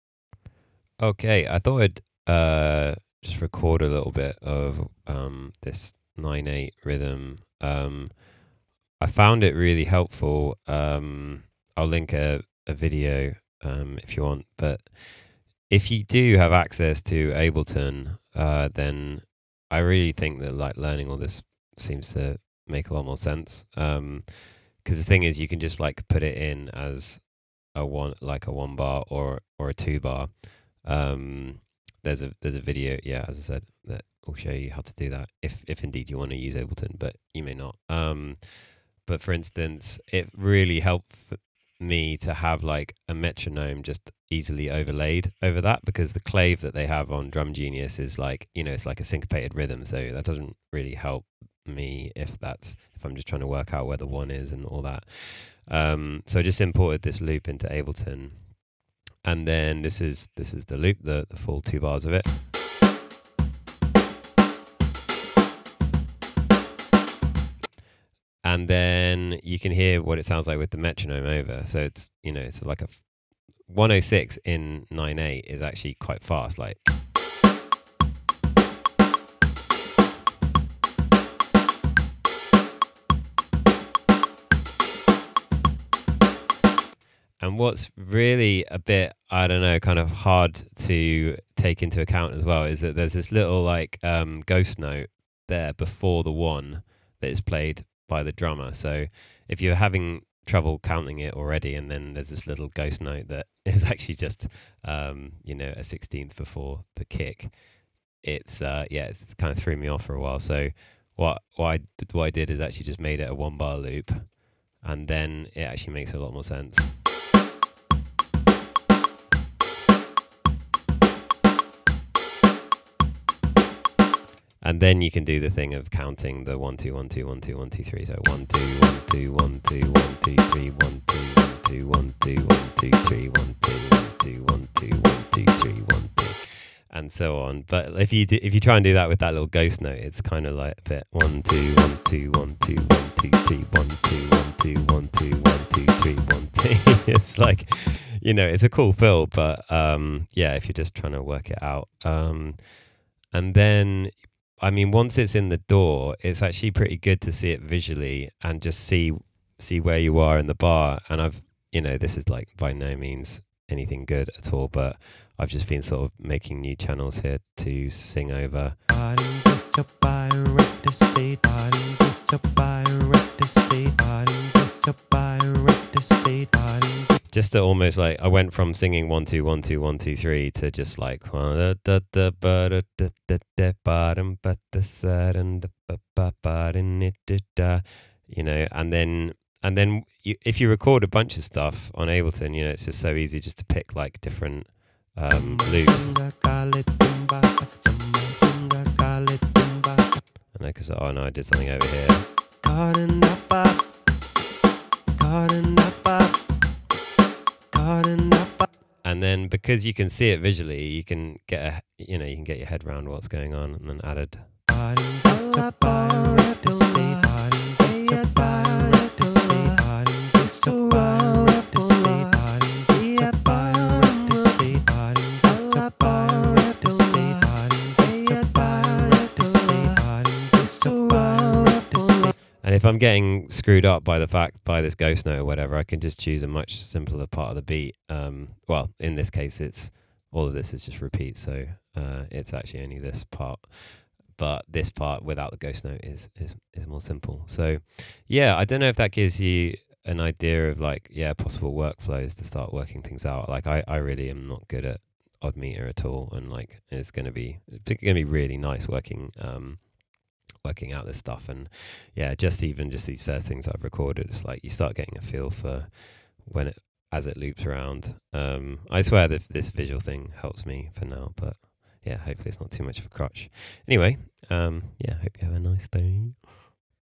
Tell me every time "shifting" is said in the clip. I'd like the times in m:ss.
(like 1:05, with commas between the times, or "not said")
not said.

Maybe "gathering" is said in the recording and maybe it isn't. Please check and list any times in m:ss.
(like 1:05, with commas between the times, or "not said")
not said.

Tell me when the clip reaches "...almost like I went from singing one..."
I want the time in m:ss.
2:57.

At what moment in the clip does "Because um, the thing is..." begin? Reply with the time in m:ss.
0:23.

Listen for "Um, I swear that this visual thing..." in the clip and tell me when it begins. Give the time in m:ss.
4:28.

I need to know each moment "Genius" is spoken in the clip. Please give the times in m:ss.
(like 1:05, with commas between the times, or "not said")
0:47.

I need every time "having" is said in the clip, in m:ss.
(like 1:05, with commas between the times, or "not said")
1:39.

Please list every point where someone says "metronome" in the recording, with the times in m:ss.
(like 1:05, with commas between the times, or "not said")
0:43, 1:10.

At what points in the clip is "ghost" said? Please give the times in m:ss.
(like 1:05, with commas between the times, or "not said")
1:34, 1:42, 2:19, 3:54, 4:05.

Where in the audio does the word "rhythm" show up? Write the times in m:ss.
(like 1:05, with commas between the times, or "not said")
0:06, 0:49.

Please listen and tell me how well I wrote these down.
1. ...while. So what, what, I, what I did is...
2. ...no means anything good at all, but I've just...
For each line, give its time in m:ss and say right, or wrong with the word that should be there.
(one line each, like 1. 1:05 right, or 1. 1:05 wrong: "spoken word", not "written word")
1. 1:50 right
2. 2:42 right.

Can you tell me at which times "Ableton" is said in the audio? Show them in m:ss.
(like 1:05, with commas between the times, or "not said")
0:17, 0:36, 0:57, 3:12.